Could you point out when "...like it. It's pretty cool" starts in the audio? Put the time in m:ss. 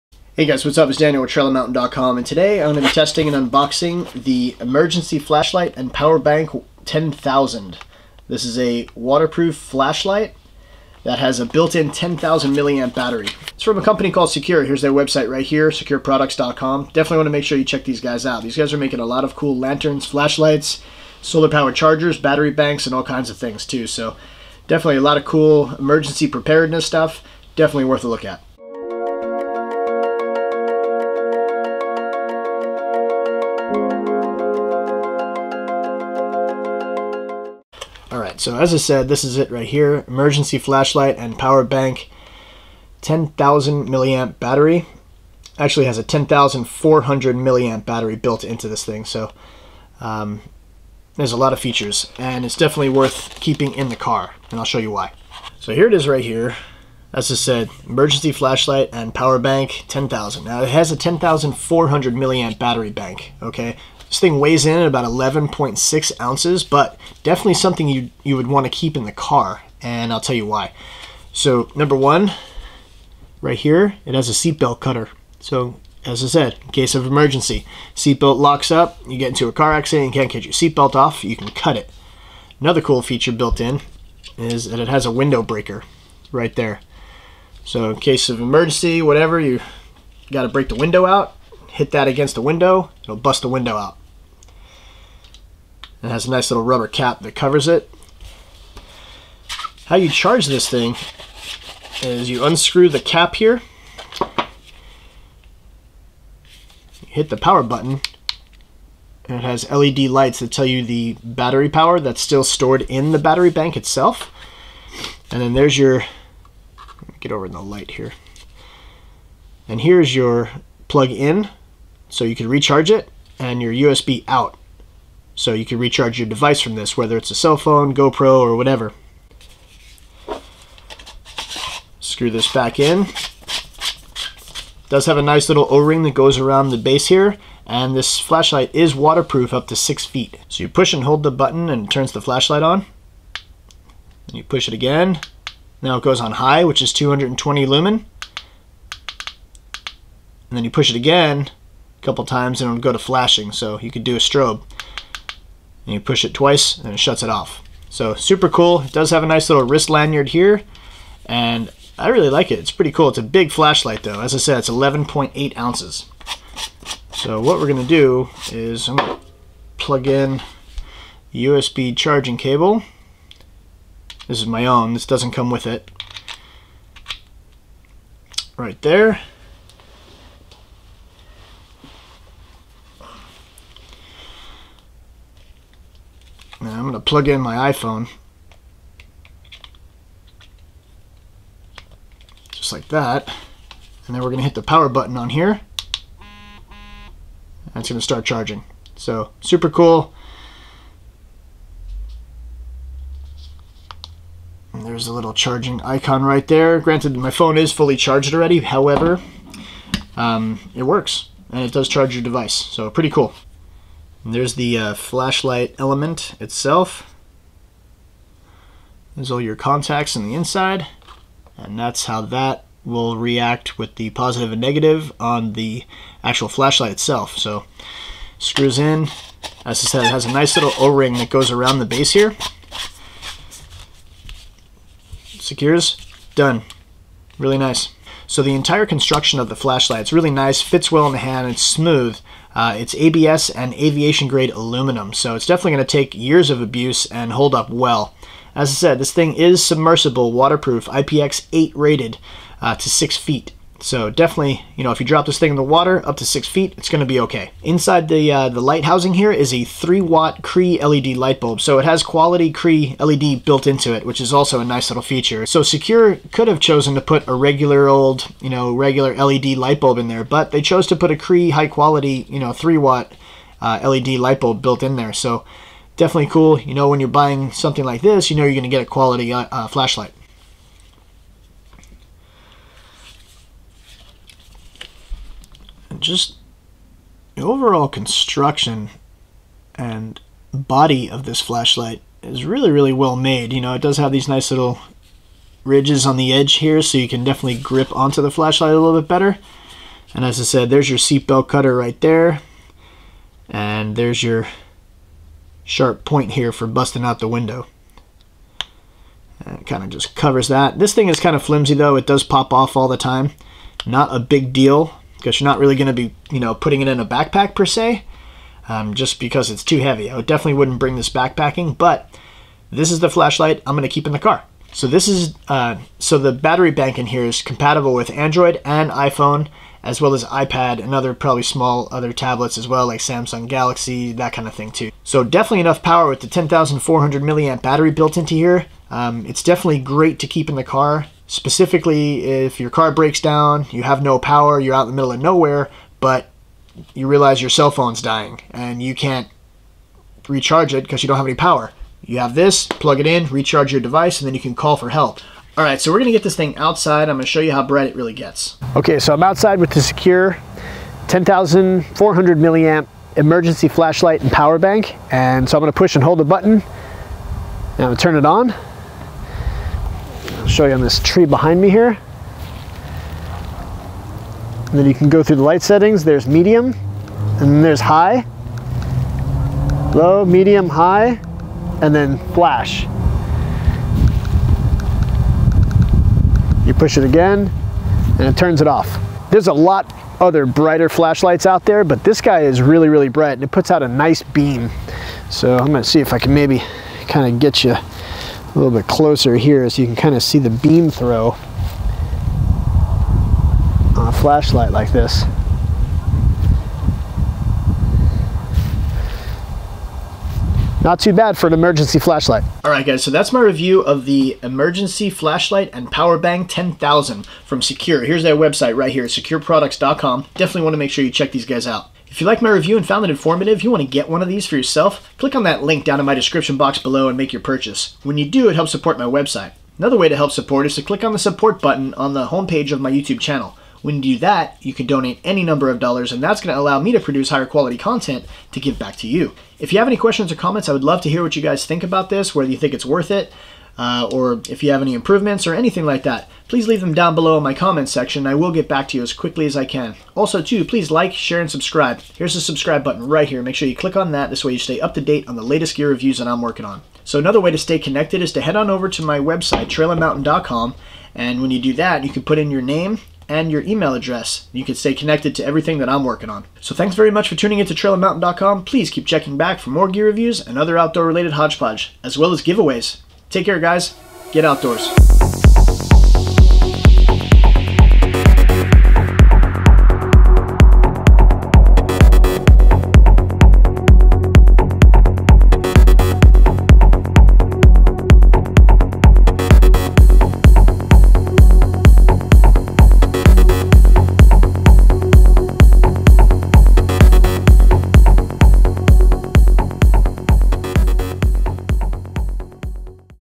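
2:42.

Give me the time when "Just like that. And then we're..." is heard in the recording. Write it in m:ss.
3:12.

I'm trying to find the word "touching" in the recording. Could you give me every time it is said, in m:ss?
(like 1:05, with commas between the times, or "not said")
not said.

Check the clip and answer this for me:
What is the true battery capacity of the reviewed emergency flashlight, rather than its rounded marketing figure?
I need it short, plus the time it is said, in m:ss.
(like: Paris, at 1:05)
10,400 milliamp, at 0:46.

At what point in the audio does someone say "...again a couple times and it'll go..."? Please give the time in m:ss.
2:30.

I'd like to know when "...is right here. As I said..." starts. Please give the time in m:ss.
0:55.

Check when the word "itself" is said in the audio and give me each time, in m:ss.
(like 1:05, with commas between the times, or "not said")
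1:53, 3:36, 3:46.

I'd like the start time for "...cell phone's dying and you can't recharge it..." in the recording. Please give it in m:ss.
5:47.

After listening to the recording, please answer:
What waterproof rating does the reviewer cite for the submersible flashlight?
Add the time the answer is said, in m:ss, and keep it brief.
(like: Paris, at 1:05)
IPX8, at 4:10.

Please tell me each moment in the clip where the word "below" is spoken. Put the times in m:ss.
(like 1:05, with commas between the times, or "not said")
7:06, 7:27.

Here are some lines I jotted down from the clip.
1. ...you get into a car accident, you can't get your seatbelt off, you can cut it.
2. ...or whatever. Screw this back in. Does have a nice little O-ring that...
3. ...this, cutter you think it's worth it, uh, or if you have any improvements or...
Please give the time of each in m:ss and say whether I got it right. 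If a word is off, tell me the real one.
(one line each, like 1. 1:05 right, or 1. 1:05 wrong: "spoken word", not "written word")
1. 1:19 right
2. 2:08 right
3. 7:22 wrong: "whether", not "cutter".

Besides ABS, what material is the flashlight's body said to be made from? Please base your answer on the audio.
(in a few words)
aviation grade aluminum.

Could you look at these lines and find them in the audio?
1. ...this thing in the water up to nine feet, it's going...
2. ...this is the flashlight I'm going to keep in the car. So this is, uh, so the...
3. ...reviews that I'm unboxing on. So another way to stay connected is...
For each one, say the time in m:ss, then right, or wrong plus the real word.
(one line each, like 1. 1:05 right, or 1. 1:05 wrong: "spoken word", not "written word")
1. 4:15 wrong: "six", not "nine"
2. 5:22 right
3. 7:35 wrong: "working", not "unboxing".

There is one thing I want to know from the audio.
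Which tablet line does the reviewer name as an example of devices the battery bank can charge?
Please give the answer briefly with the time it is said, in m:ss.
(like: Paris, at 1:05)
Samsung Galaxy, at 5:33.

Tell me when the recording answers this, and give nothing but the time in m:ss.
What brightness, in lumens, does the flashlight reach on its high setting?
2:26.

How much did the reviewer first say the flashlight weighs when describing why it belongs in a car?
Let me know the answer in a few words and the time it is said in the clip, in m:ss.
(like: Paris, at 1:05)
11.6 ounces, at 1:05.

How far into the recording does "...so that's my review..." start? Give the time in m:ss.
6:53.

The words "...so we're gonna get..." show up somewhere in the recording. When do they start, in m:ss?
5:55.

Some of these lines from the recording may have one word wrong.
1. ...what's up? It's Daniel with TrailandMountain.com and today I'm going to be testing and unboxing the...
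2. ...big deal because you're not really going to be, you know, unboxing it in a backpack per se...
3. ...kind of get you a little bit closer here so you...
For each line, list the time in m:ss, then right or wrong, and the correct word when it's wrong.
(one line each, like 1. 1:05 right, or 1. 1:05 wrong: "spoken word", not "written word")
1. 0:00 right
2. 5:14 wrong: "putting", not "unboxing"
3. 6:37 right.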